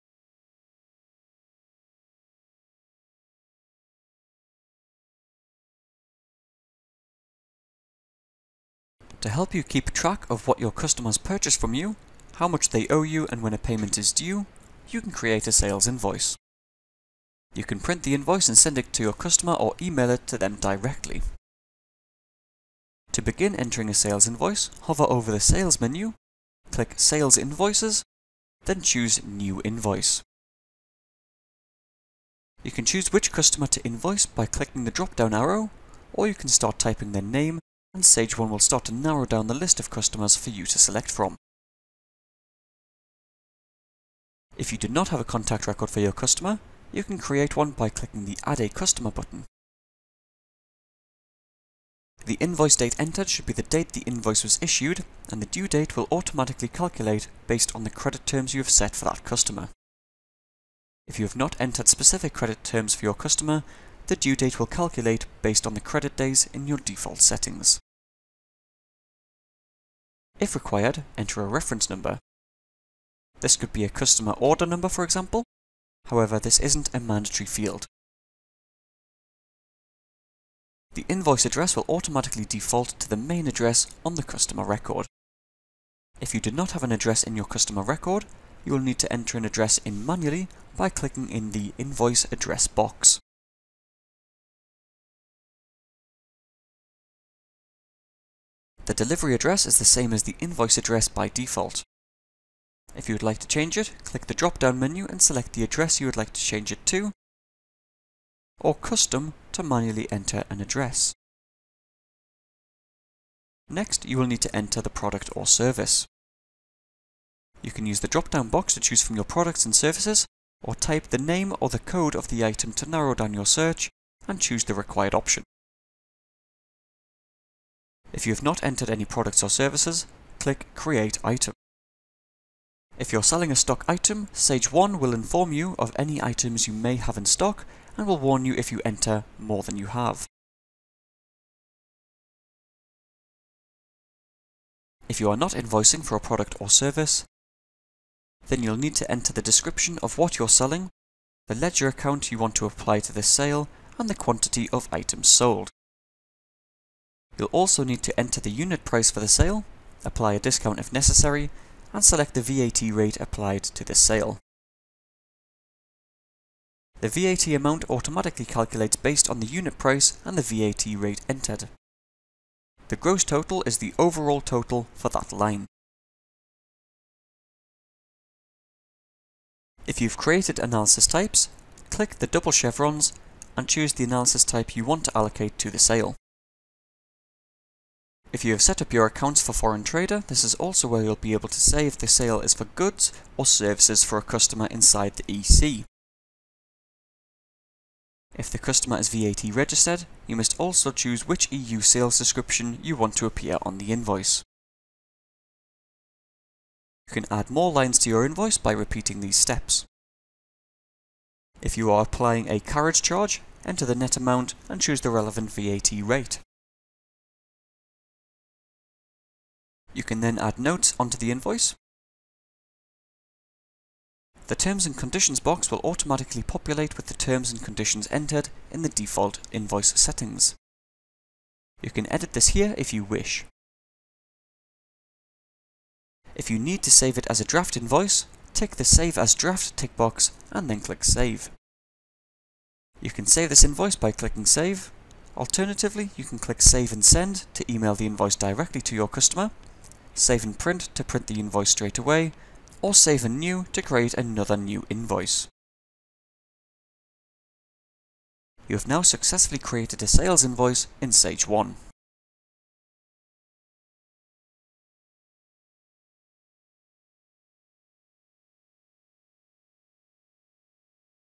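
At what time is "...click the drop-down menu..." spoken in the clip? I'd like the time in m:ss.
1:44.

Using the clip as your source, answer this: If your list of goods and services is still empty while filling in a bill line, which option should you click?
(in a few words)
Create Item.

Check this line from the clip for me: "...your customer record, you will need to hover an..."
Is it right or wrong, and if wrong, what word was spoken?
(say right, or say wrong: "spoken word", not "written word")
wrong: "enter", not "hover".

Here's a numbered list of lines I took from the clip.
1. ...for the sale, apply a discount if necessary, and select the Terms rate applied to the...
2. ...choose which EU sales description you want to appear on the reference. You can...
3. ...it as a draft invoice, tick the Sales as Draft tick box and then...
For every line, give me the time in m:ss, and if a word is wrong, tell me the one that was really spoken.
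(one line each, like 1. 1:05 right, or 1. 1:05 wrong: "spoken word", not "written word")
1. 2:39 wrong: "VAT", not "Terms"
2. 3:20 wrong: "invoice", not "reference"
3. 3:57 wrong: "Save", not "Sales".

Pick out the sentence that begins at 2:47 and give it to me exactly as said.
The VAT amount automatically calculates based on the unit price and the VAT rate entered.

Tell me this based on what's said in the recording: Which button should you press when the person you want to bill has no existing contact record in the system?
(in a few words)
Add a Customer.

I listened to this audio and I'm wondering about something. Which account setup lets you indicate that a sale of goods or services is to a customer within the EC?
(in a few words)
Foreign Trader.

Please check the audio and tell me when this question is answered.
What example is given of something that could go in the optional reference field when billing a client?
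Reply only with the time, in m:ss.
1:13.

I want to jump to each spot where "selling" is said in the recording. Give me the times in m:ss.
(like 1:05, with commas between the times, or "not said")
2:13, 2:30.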